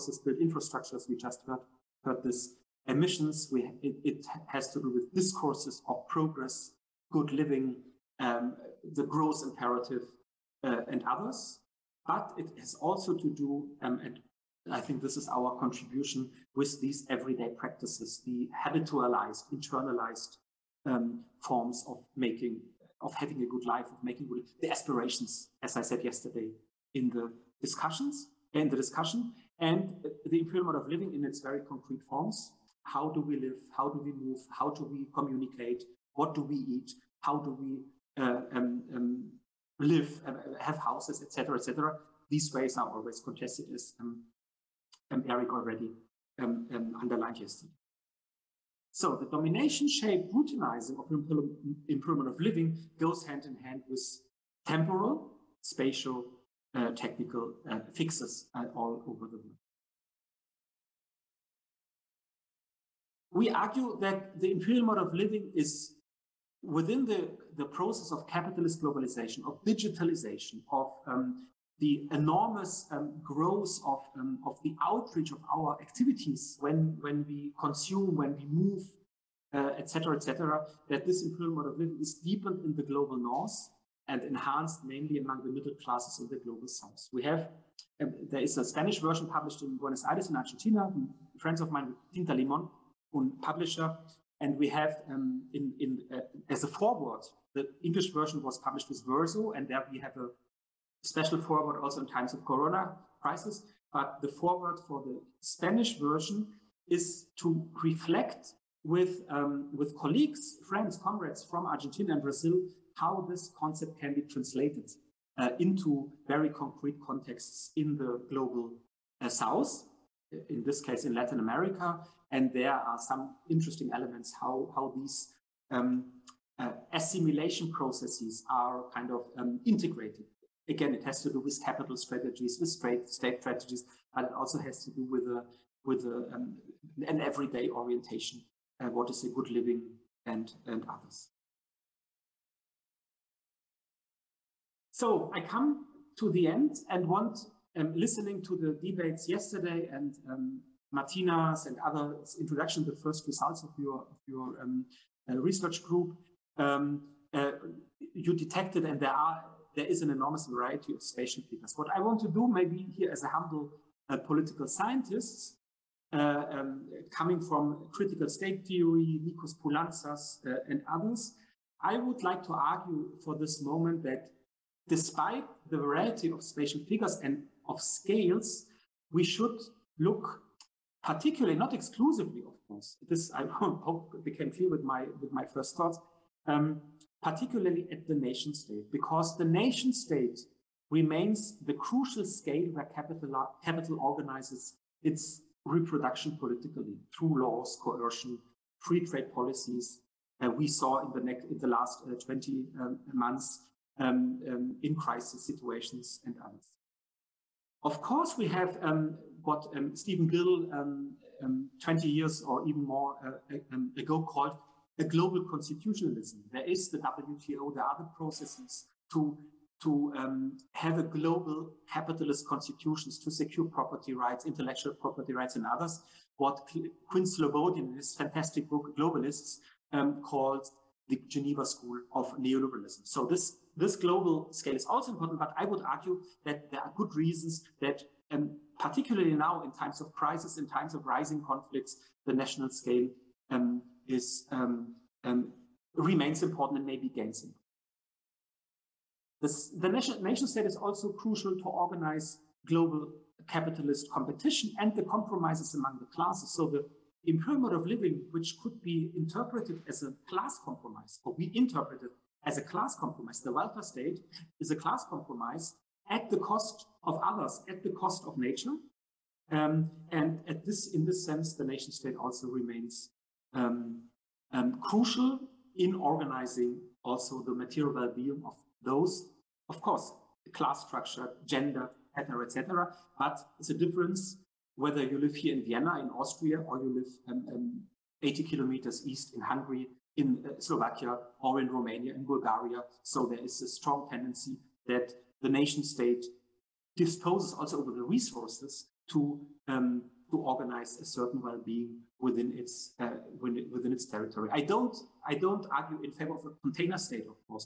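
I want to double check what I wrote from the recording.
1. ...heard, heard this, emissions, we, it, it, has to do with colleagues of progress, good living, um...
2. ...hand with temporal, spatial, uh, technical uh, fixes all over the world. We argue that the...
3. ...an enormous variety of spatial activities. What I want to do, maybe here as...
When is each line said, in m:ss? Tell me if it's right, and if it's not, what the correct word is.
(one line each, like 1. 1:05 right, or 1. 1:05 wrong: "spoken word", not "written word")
1. 0:01 wrong: "discourses", not "colleagues"
2. 0:53 right
3. 2:40 wrong: "figures", not "activities".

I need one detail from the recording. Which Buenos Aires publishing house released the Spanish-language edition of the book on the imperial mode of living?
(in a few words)
Tinta Limon.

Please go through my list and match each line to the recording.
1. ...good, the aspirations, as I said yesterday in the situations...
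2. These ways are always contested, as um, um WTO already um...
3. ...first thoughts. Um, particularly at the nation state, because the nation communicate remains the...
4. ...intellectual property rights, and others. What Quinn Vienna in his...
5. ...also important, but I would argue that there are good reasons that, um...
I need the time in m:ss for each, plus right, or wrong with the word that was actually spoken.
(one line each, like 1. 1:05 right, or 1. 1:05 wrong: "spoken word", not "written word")
1. 0:24 wrong: "discussions", not "situations"
2. 0:42 wrong: "Eric", not "WTO"
3. 3:05 wrong: "state", not "communicate"
4. 3:44 wrong: "Slobodian", not "Vienna"
5. 3:54 right.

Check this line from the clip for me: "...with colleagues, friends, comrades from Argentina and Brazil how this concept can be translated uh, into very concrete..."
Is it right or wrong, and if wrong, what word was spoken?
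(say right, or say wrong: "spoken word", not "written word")
right.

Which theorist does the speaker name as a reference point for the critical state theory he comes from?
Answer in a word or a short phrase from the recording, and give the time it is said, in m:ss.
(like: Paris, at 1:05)
Nikos Poulantzas, at 2:49.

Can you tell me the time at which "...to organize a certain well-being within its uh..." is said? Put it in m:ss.
5:00.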